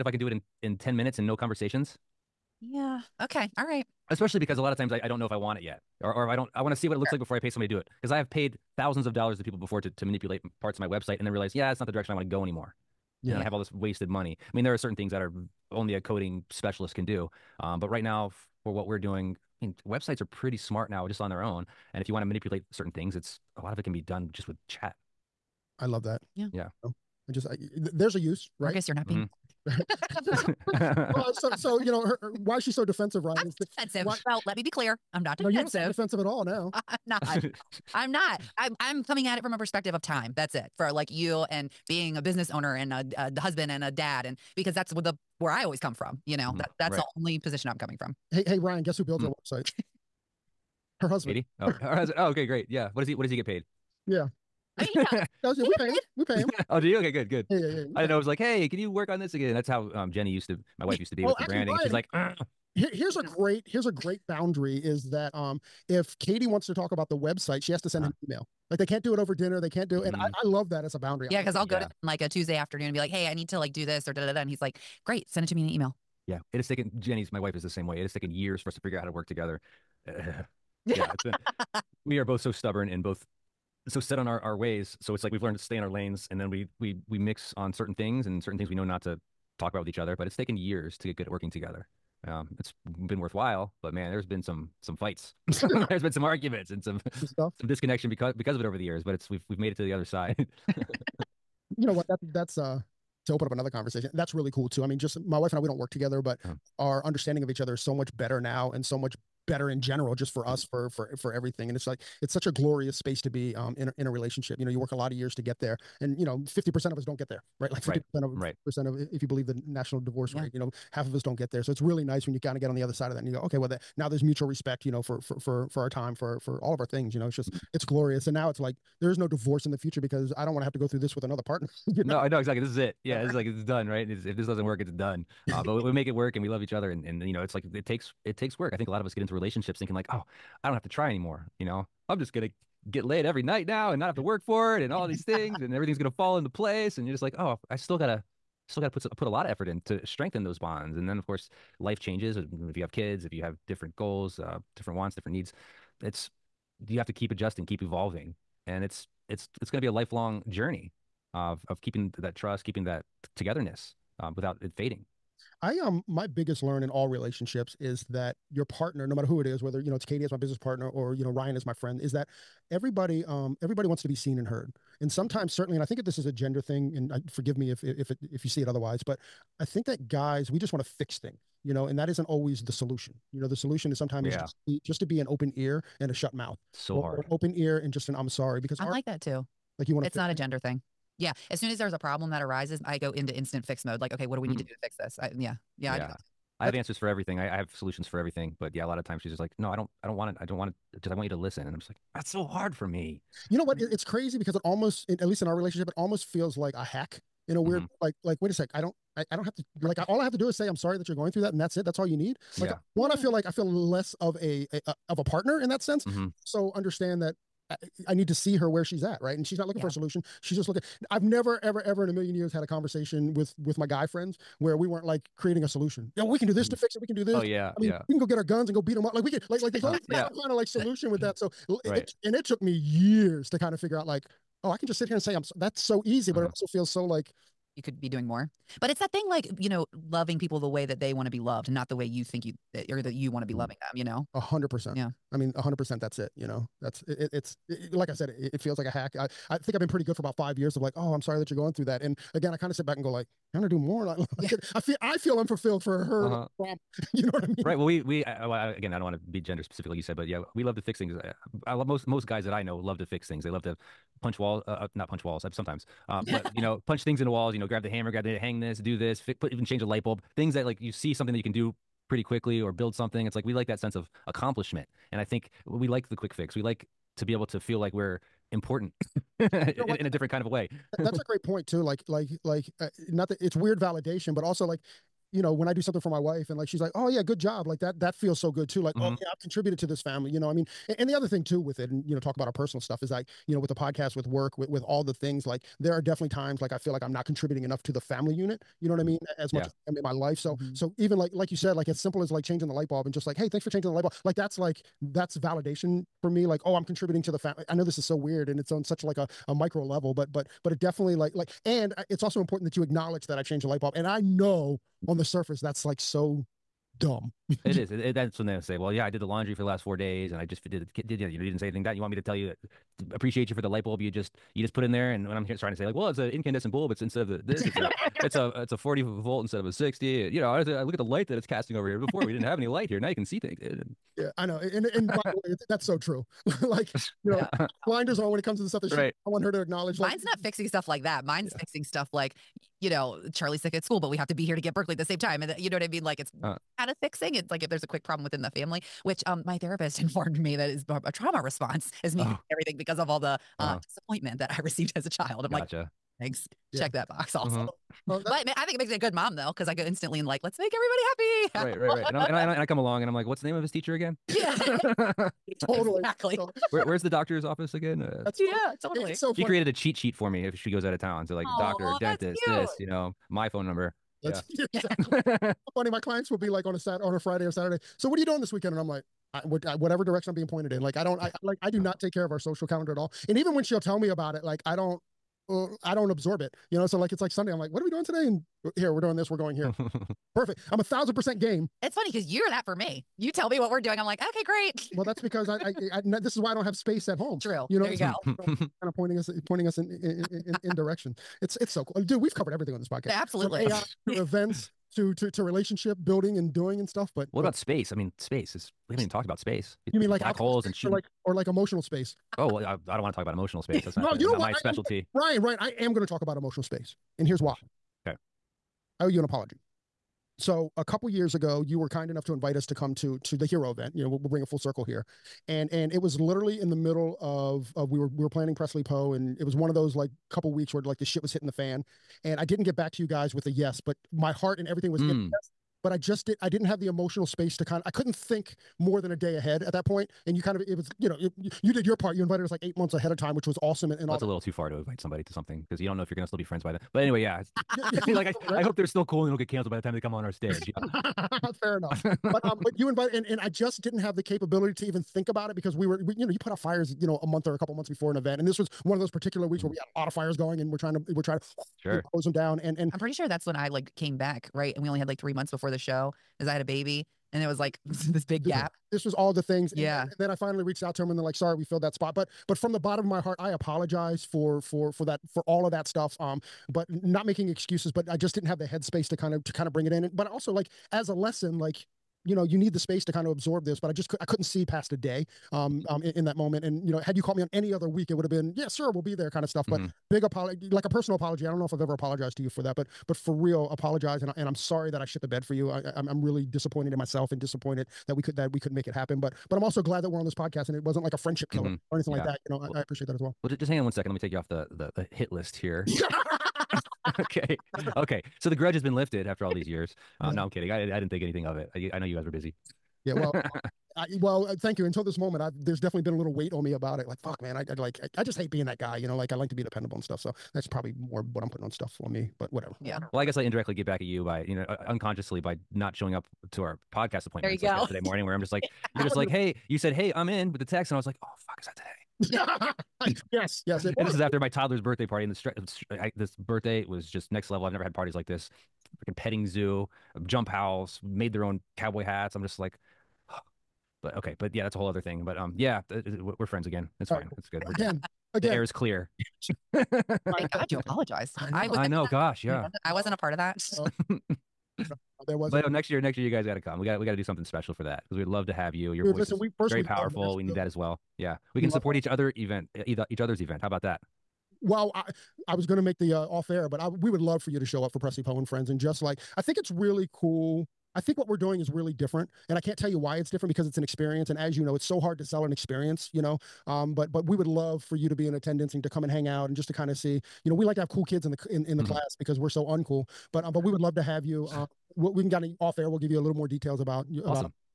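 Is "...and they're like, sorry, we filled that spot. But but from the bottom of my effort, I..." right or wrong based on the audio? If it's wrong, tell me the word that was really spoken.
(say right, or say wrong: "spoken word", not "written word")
wrong: "heart", not "effort".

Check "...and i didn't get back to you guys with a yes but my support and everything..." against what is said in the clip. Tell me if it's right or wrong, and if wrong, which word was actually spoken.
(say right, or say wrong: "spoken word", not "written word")
wrong: "heart", not "support".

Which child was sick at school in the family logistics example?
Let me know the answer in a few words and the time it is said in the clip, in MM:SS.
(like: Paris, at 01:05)
Charlie, at 05:43.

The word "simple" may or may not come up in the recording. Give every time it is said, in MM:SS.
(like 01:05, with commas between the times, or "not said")
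05:01.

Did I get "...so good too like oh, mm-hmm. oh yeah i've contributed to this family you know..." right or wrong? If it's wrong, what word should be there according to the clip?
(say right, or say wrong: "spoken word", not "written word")
right.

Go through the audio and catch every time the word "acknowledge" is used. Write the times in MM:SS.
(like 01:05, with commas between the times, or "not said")
05:12, 05:39.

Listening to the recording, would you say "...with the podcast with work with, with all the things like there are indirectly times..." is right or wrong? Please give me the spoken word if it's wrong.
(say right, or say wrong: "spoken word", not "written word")
wrong: "definitely", not "indirectly".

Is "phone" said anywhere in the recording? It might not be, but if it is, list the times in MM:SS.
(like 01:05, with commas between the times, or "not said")
06:13.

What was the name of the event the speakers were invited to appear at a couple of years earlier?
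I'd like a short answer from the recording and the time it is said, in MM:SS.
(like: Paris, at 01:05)
the hero event, at 07:03.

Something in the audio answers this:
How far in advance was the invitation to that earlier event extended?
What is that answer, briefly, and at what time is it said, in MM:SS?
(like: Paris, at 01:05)
8 months, at 07:22.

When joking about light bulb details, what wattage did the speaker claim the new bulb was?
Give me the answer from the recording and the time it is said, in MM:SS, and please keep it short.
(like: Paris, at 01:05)
40, at 05:28.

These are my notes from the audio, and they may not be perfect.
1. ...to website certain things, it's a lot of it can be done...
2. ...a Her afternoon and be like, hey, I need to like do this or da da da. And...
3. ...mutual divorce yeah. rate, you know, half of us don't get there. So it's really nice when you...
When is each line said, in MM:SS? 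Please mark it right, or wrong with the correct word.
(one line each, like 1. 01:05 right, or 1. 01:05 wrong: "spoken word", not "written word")
1. 00:22 wrong: "manipulate", not "website"
2. 01:12 wrong: "Tuesday", not "Her"
3. 01:59 wrong: "national", not "mutual".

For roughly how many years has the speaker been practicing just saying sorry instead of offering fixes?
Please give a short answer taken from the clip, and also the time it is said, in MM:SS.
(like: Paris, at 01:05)
5, at 04:10.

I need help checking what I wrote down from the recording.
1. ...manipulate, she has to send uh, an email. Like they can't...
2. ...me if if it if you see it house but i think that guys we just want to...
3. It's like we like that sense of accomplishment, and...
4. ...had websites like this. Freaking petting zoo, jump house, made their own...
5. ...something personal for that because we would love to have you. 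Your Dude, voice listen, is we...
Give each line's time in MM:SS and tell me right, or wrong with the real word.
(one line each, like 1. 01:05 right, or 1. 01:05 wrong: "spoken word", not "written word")
1. 01:07 wrong: "website", not "manipulate"
2. 02:57 wrong: "otherwise", not "house"
3. 04:33 right
4. 08:57 wrong: "parties", not "websites"
5. 09:17 wrong: "special", not "personal".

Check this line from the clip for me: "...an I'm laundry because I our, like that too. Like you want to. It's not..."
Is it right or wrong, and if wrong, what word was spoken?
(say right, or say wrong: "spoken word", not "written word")
wrong: "sorry", not "laundry".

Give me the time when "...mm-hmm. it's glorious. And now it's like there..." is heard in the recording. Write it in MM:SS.
02:07.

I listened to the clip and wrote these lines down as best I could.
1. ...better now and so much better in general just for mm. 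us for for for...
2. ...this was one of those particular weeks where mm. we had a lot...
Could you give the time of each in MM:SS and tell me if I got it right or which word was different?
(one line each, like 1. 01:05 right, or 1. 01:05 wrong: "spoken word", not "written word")
1. 01:48 right
2. 07:38 right.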